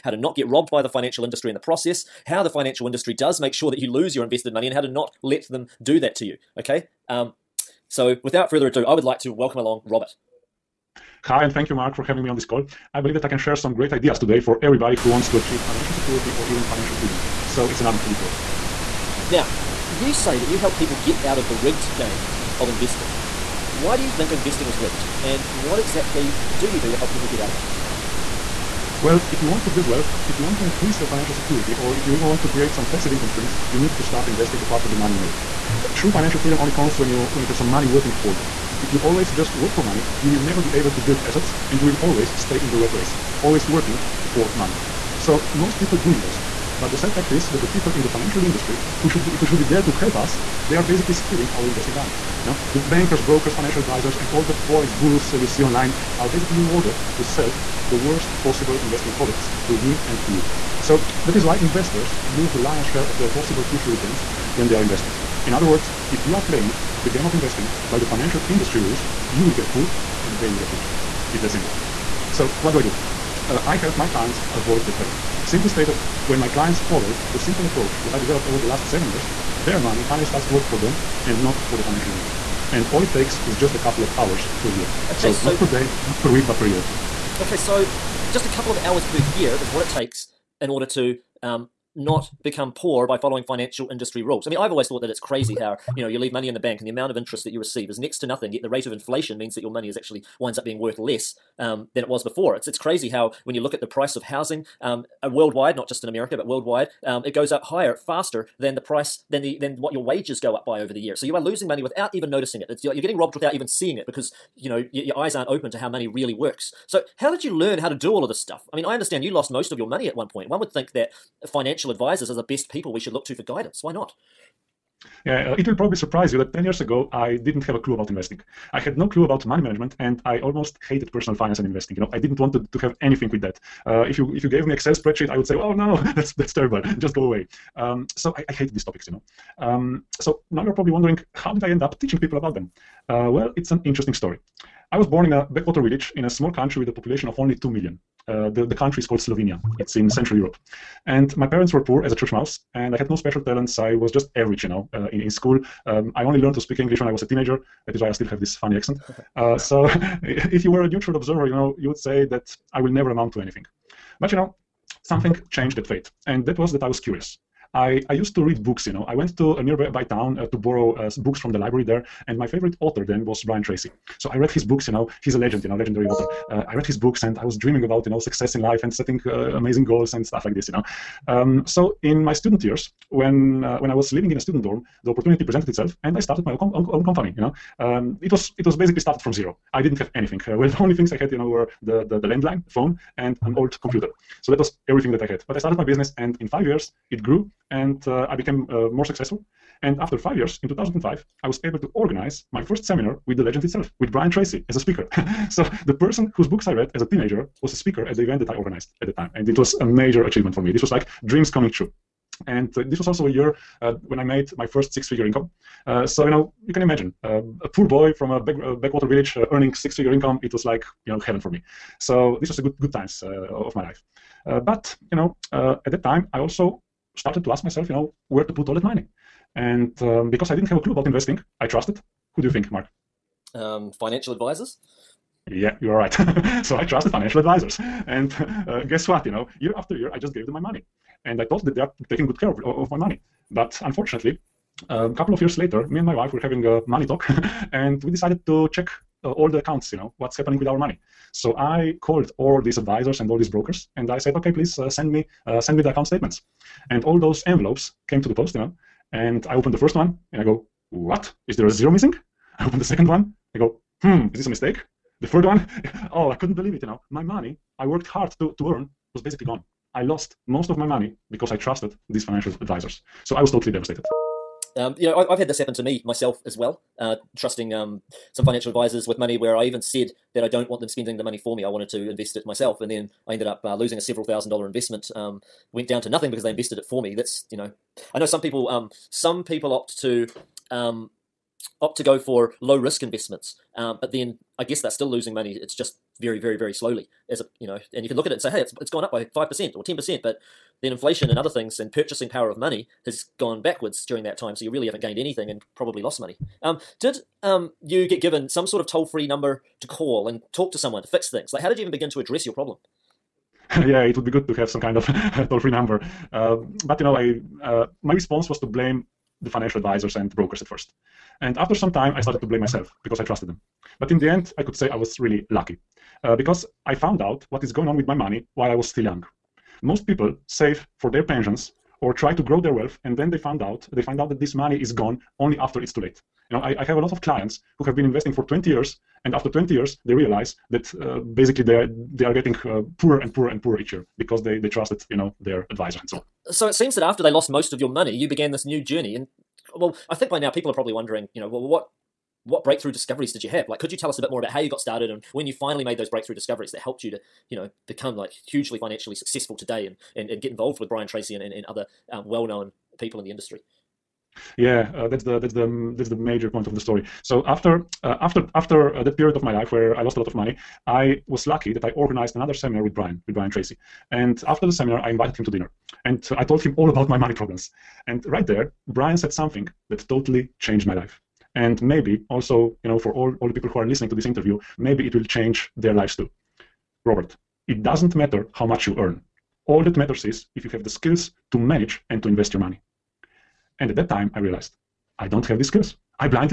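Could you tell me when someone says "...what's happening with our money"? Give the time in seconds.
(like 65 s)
250 s.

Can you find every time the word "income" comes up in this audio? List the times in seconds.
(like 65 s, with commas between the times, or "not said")
33 s, 215 s, 220 s.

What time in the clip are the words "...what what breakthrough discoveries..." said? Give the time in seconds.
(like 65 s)
351 s.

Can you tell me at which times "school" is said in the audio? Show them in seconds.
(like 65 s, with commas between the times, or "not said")
155 s.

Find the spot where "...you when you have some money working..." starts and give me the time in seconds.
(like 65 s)
37 s.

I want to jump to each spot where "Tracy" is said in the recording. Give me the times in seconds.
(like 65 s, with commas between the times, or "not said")
173 s, 204 s, 361 s, 373 s.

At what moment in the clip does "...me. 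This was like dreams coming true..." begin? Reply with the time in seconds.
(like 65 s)
210 s.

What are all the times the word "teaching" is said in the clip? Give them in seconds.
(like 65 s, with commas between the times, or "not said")
141 s.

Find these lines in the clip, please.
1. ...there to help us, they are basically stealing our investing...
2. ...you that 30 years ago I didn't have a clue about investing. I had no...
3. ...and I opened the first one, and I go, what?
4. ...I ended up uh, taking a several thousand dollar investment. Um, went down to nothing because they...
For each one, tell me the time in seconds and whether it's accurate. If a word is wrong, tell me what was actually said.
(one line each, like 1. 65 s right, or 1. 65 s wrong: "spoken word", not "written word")
1. 49 s right
2. 126 s wrong: "10", not "30"
3. 259 s right
4. 283 s wrong: "losing", not "taking".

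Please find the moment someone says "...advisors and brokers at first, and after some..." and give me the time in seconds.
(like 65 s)
319 s.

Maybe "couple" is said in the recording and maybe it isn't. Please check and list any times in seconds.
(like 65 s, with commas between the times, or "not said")
83 s, 88 s, 245 s.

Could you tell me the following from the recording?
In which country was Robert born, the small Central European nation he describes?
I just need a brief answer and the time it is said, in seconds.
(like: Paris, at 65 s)
Slovenia, at 149 s.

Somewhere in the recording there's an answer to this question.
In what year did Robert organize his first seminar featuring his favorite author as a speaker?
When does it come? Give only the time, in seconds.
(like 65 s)
200 s.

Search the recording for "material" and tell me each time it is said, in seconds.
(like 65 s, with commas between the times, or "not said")
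not said.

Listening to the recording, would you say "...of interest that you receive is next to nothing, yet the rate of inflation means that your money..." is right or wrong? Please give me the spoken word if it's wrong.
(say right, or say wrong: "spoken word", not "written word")
right.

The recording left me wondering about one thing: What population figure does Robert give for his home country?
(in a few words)
2 million.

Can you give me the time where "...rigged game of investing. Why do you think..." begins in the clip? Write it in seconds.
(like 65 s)
21 s.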